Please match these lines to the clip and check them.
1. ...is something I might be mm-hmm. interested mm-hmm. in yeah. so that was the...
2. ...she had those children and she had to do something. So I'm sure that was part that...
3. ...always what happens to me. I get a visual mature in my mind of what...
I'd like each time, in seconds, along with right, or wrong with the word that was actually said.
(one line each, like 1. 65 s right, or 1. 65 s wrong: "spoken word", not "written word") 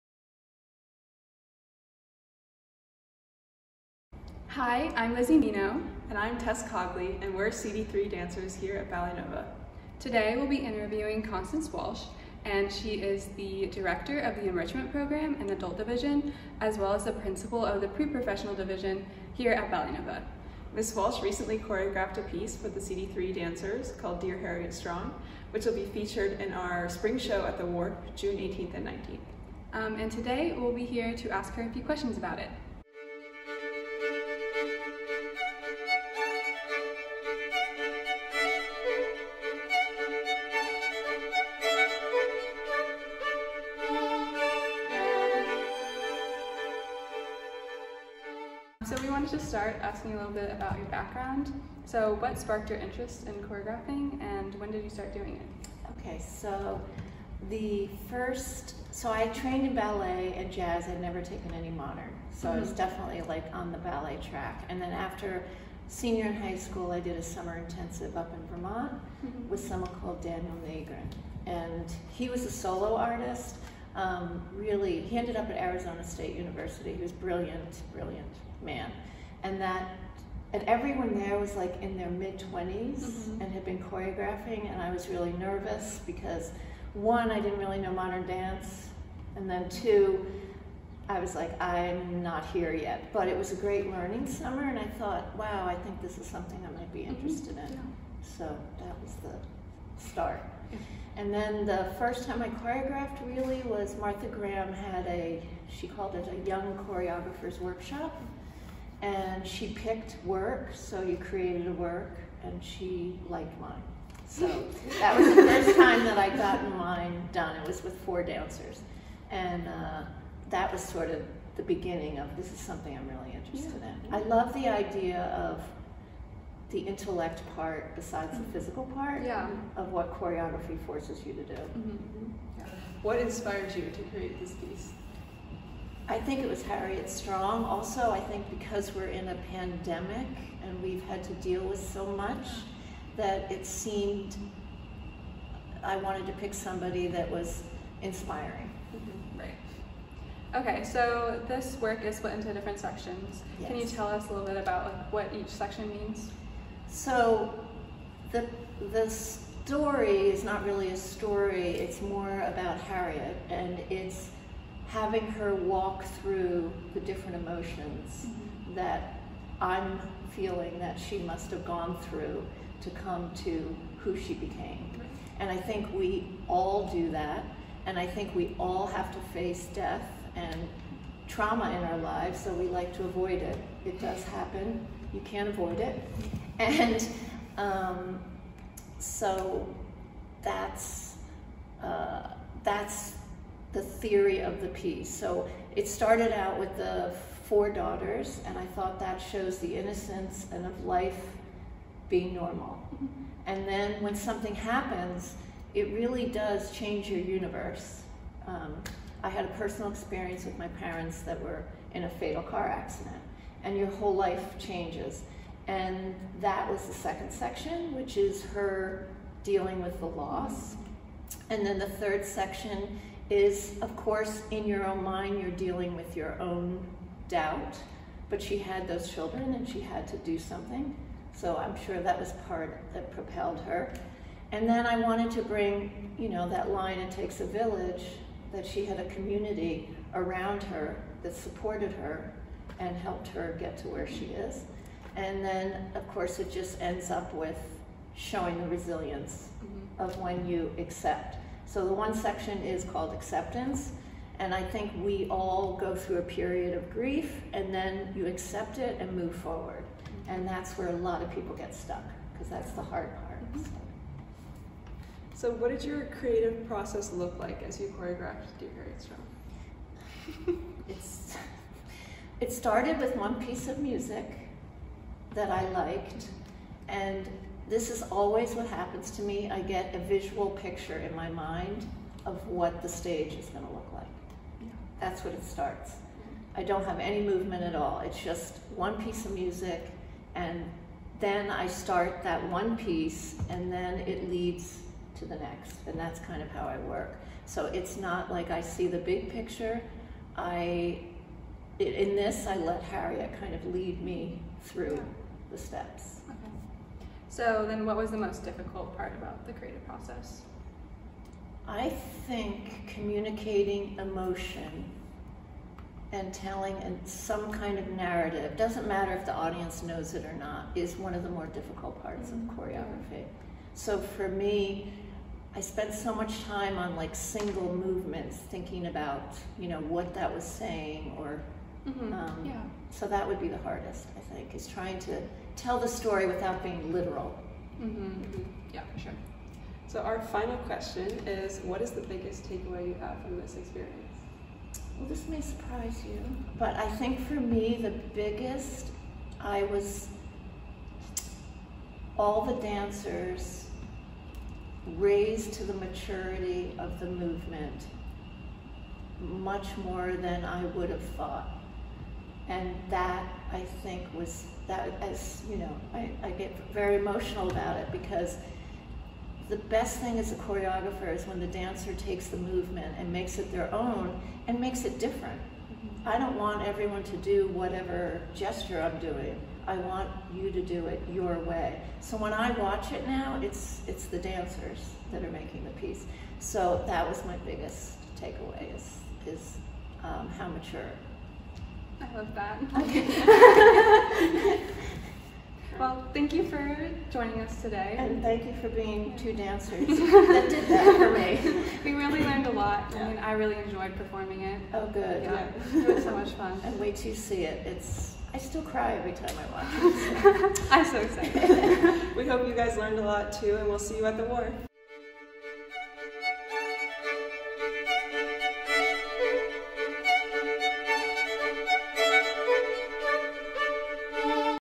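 1. 96 s right
2. 228 s right
3. 278 s wrong: "picture", not "mature".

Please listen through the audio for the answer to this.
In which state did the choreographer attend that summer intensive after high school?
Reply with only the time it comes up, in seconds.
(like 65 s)
68 s.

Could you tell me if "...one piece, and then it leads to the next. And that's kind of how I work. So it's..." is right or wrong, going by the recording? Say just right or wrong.
right.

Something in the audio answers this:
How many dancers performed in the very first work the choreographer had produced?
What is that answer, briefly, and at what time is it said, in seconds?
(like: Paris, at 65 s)
4, at 118 s.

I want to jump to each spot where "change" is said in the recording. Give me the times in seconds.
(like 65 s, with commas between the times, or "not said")
206 s, 214 s.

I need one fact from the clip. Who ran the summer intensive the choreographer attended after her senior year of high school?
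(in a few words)
Daniel Nagrin.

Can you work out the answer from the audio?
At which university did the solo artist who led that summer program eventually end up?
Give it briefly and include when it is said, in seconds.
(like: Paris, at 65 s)
Arizona State University, at 75 s.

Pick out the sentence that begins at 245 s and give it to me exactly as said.
And then, of course, it just ends up with showing the resilience mm -hmm.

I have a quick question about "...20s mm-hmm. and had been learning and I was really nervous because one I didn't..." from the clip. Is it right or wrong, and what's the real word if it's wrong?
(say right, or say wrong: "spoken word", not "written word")
wrong: "choreographing", not "learning".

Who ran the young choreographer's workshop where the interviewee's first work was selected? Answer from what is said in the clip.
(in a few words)
Martha Graham.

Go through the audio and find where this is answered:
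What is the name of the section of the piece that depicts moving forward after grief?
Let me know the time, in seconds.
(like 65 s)
253 s.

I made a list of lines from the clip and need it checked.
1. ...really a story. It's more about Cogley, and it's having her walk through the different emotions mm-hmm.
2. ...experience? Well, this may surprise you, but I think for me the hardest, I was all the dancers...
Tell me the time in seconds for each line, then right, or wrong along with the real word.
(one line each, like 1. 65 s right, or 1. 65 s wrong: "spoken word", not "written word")
1. 160 s wrong: "Harriet", not "Cogley"
2. 343 s wrong: "biggest", not "hardest".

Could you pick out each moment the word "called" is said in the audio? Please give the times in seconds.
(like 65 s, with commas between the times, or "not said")
24 s, 70 s, 105 s, 252 s.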